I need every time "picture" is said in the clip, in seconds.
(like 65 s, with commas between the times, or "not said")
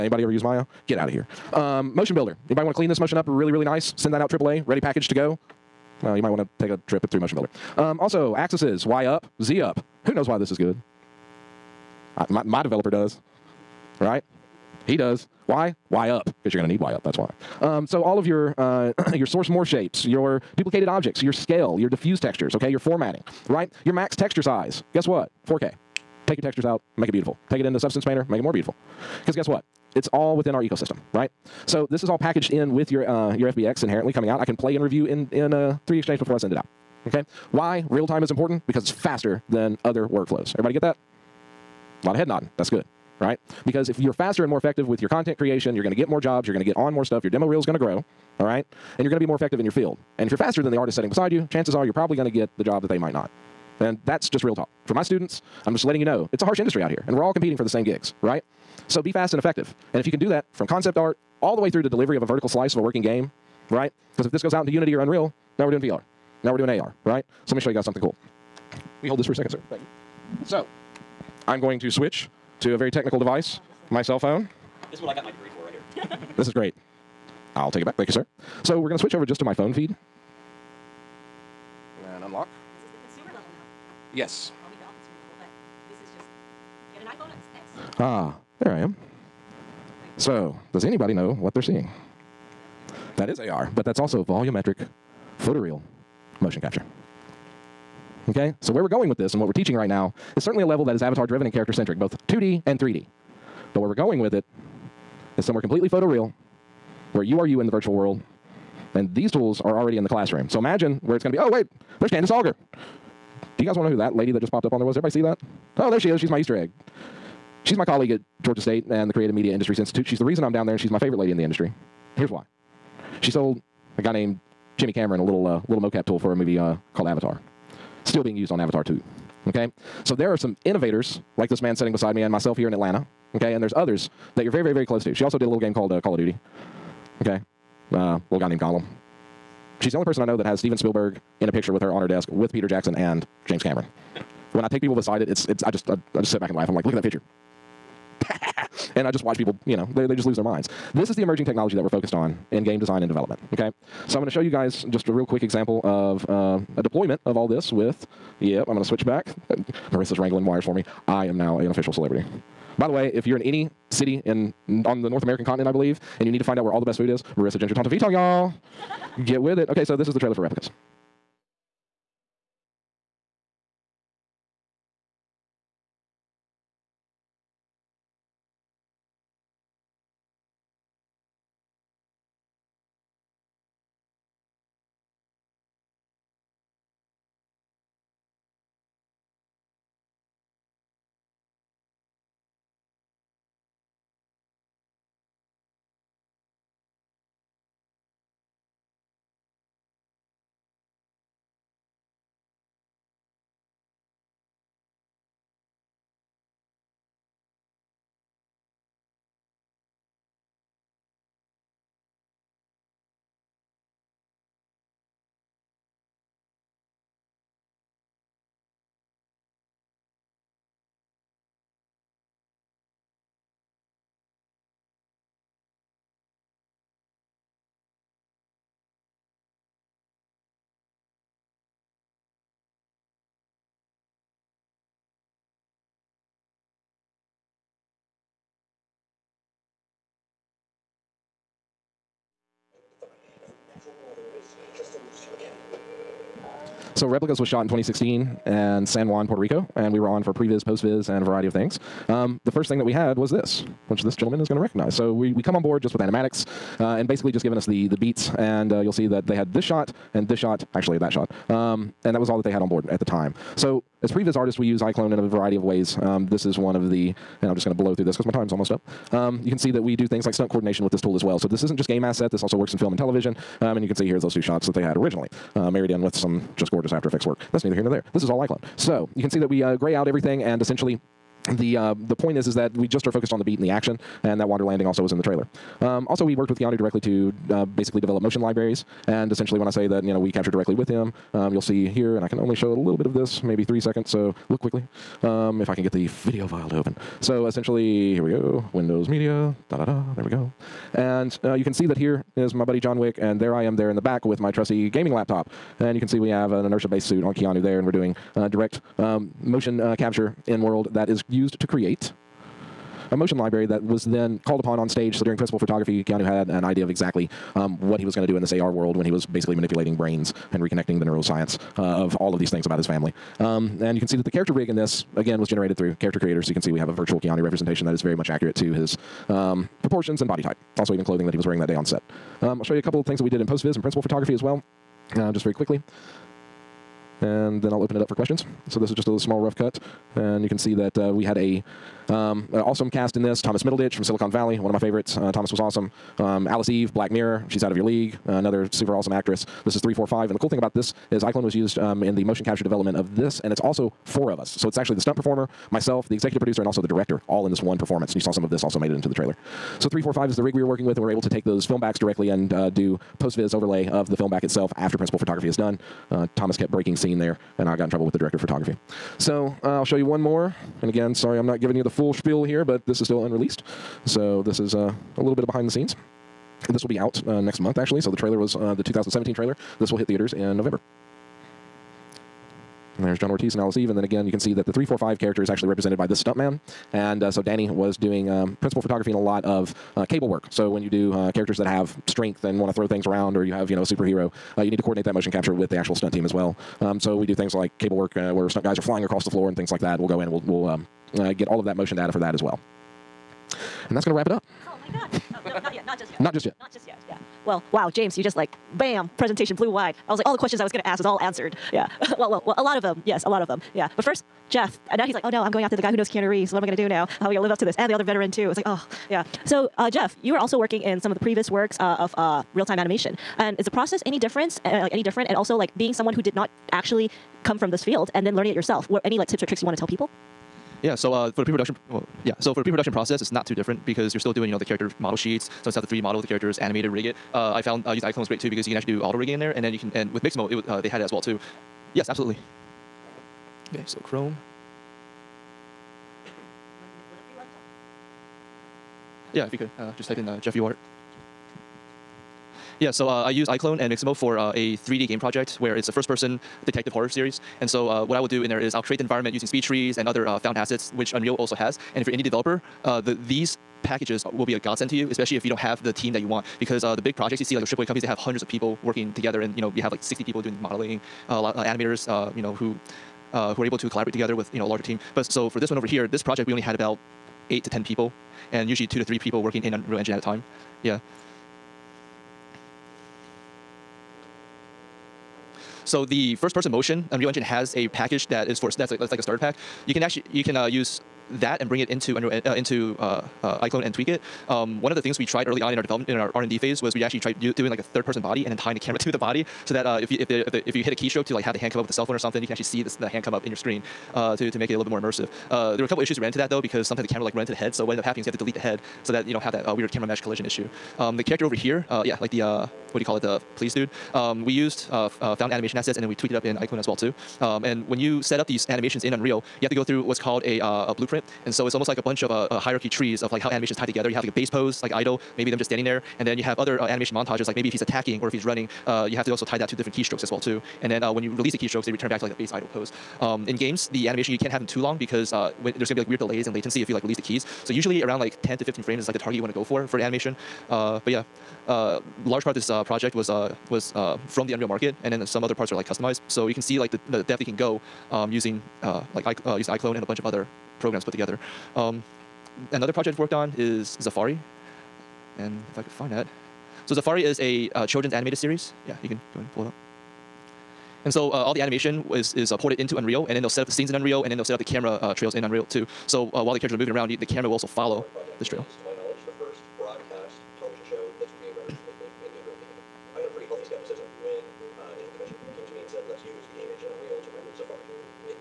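141 s, 147 s.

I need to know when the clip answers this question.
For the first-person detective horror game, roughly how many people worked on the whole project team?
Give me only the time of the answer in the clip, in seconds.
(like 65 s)
477 s.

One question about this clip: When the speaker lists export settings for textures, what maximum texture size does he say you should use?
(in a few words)
4K.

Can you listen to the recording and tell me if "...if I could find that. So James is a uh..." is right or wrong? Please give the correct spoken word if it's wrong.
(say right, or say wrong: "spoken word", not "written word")
wrong: "Zafari", not "James".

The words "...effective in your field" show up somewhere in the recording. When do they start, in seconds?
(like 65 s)
49 s.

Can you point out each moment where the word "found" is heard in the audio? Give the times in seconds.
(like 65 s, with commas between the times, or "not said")
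437 s, 460 s, 515 s.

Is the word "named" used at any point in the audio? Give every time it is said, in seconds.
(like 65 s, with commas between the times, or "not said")
124 s, 138 s.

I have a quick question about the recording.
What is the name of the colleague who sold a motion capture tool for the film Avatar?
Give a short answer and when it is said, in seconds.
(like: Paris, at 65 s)
Candice Alger, at 112 s.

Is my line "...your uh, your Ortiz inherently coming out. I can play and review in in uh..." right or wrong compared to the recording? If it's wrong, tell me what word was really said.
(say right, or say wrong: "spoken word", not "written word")
wrong: "FBX", not "Ortiz".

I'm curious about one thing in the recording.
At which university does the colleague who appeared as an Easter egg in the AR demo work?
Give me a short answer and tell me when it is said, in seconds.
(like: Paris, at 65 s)
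Georgia State, at 118 s.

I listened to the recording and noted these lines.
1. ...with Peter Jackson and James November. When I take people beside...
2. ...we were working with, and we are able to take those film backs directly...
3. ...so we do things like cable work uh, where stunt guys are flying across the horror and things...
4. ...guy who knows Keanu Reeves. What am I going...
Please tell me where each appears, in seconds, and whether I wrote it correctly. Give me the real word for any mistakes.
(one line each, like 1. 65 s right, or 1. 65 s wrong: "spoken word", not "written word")
1. 142 s wrong: "Cameron", not "November"
2. 360 s right
3. 396 s wrong: "floor", not "horror"
4. 415 s right.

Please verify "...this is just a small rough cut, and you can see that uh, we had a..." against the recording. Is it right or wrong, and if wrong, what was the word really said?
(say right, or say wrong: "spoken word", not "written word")
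right.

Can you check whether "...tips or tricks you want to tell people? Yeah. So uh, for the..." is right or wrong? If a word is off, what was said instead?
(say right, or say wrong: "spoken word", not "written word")
right.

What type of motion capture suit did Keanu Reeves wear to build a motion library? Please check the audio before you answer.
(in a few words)
Inertia based suit.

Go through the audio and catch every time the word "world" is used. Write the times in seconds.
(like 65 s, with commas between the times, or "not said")
107 s, 310 s, 318 s.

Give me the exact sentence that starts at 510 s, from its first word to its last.
Um, the character over here, uh, yeah, like the, uh, what do you call it?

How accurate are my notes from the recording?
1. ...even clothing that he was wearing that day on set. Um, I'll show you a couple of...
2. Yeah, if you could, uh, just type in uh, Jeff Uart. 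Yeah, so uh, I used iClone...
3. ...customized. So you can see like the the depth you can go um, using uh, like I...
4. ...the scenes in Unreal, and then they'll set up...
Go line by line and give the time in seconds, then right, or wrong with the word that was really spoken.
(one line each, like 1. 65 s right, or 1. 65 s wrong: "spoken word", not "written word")
1. 330 s right
2. 449 s right
3. 545 s right
4. 563 s right.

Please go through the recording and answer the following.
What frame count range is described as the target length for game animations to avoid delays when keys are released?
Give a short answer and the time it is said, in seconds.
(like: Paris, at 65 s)
10 to 15 frames, at 538 s.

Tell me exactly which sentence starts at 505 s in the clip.
Uh, there were a couple issues that ran into that though, because sometimes the camera like ran into the head.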